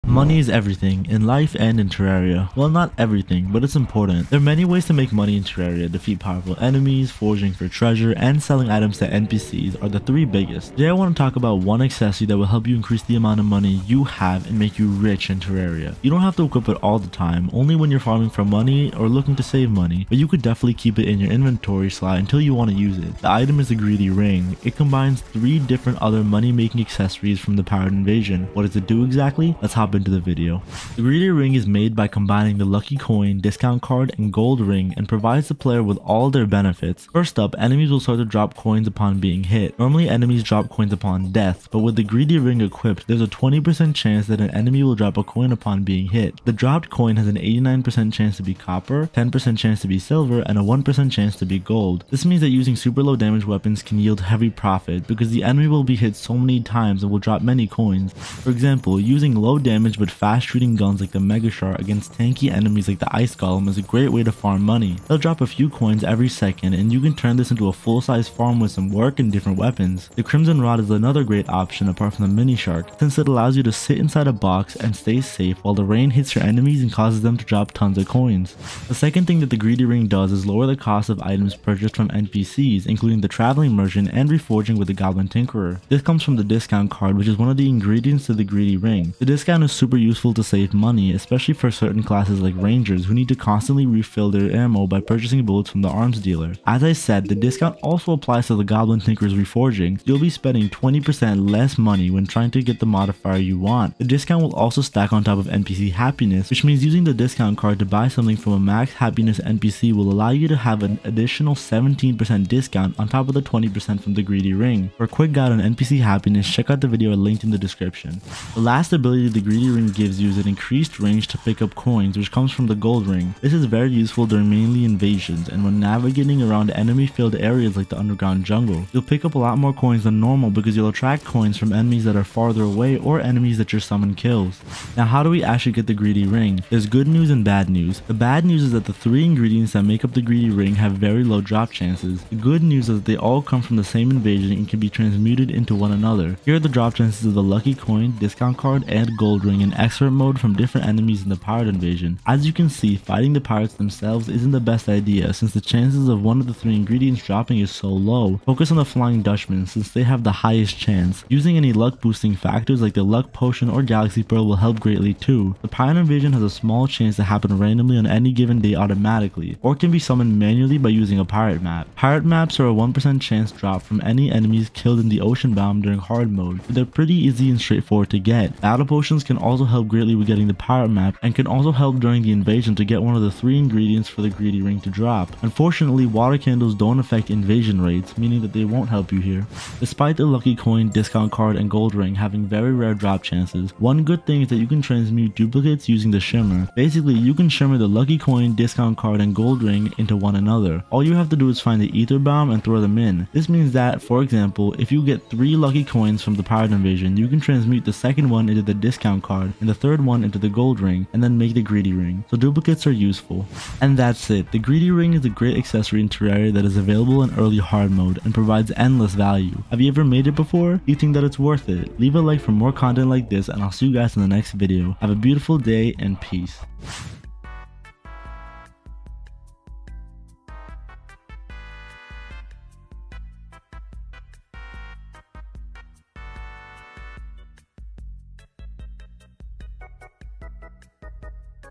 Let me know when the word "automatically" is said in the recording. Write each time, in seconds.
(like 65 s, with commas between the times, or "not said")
168 s.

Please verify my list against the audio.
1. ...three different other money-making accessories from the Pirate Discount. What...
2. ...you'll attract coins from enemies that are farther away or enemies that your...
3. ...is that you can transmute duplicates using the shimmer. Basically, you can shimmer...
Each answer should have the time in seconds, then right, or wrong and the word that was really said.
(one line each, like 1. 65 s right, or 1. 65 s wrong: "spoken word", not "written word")
1. 25 s wrong: "Invasion", not "Discount"
2. 130 s right
3. 194 s right.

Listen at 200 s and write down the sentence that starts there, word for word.
All you have to do is find the Aether biome and throw them in.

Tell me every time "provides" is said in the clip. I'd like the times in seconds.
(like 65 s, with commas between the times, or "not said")
35 s, 218 s.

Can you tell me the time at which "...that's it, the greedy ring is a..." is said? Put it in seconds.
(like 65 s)
213 s.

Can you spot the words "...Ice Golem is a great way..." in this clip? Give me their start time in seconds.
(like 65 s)
63 s.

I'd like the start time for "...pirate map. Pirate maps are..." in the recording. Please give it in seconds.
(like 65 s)
171 s.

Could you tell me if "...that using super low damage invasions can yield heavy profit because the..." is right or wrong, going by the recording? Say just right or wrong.
wrong.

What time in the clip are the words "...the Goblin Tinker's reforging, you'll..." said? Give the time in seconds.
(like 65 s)
98 s.